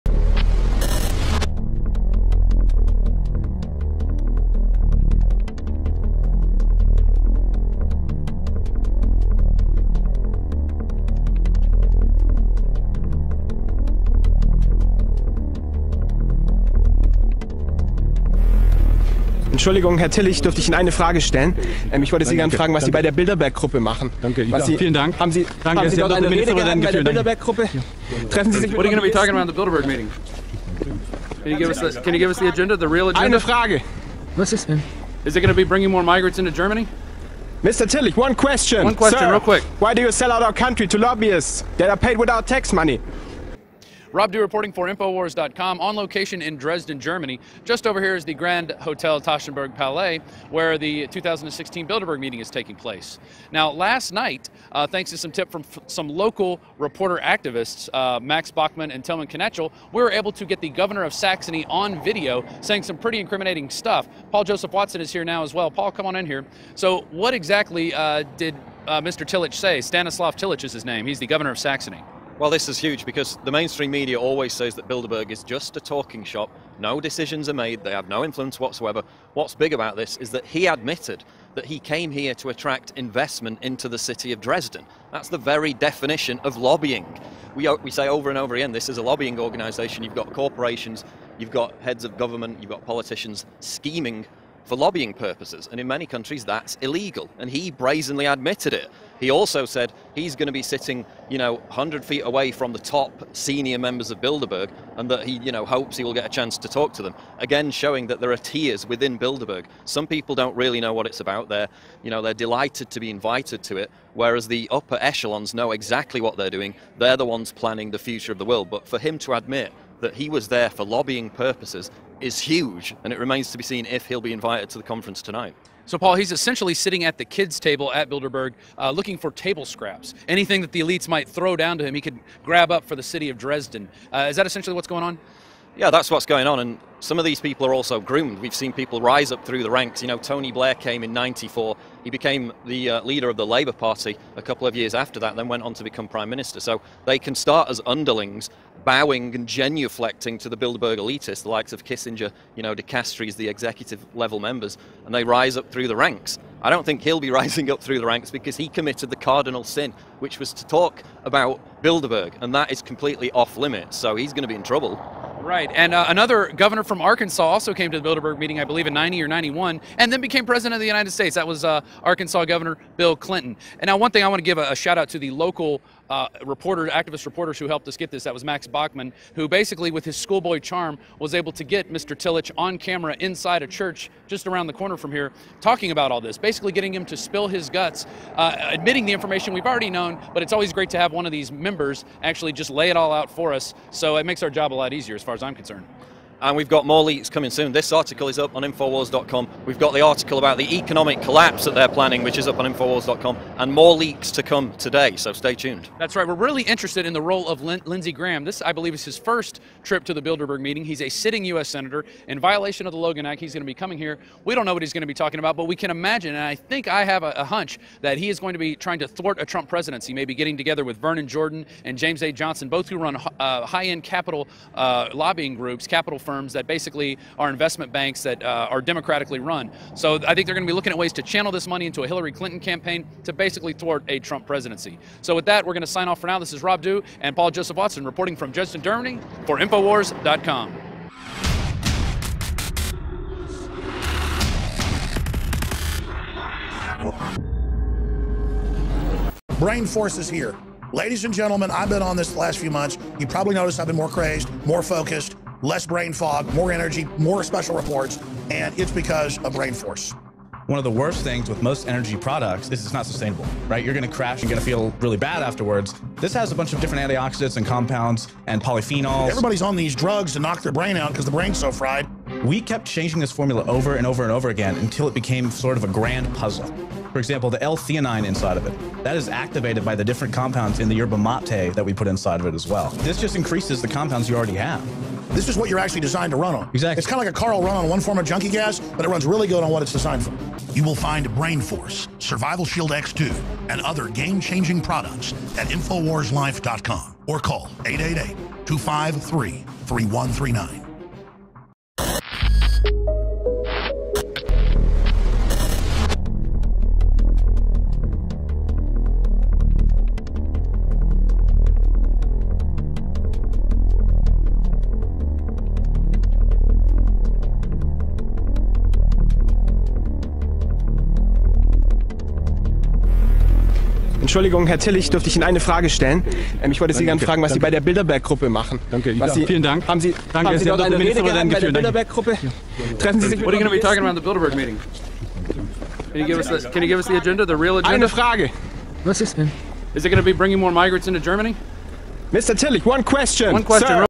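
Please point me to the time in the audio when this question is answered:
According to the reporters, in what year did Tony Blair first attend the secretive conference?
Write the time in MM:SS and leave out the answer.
02:21.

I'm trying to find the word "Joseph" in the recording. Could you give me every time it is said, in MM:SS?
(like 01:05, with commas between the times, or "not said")
01:04, 03:57.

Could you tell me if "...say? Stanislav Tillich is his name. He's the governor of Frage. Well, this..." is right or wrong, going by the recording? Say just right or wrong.
wrong.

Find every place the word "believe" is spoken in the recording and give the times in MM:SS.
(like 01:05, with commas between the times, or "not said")
02:48, 03:28.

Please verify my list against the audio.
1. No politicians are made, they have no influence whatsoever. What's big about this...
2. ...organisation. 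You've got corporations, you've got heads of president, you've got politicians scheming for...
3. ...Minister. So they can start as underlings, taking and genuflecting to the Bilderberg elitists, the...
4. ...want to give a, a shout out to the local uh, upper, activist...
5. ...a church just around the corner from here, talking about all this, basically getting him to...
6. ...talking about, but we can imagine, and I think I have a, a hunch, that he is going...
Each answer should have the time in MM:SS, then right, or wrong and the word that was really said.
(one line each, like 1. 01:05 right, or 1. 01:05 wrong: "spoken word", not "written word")
1. 01:16 wrong: "decisions", not "politicians"
2. 01:29 wrong: "government", not "president"
3. 02:26 wrong: "bowing", not "taking"
4. 02:54 wrong: "reporter", not "upper"
5. 03:03 right
6. 03:35 right.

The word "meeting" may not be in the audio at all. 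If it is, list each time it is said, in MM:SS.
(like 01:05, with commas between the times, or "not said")
00:29, 00:52, 02:48, 03:30, 05:34.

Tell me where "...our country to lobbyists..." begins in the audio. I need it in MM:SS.
00:40.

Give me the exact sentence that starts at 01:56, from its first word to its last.
They're the ones planning the future of the world.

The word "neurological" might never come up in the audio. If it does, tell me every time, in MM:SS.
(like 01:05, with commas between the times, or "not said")
not said.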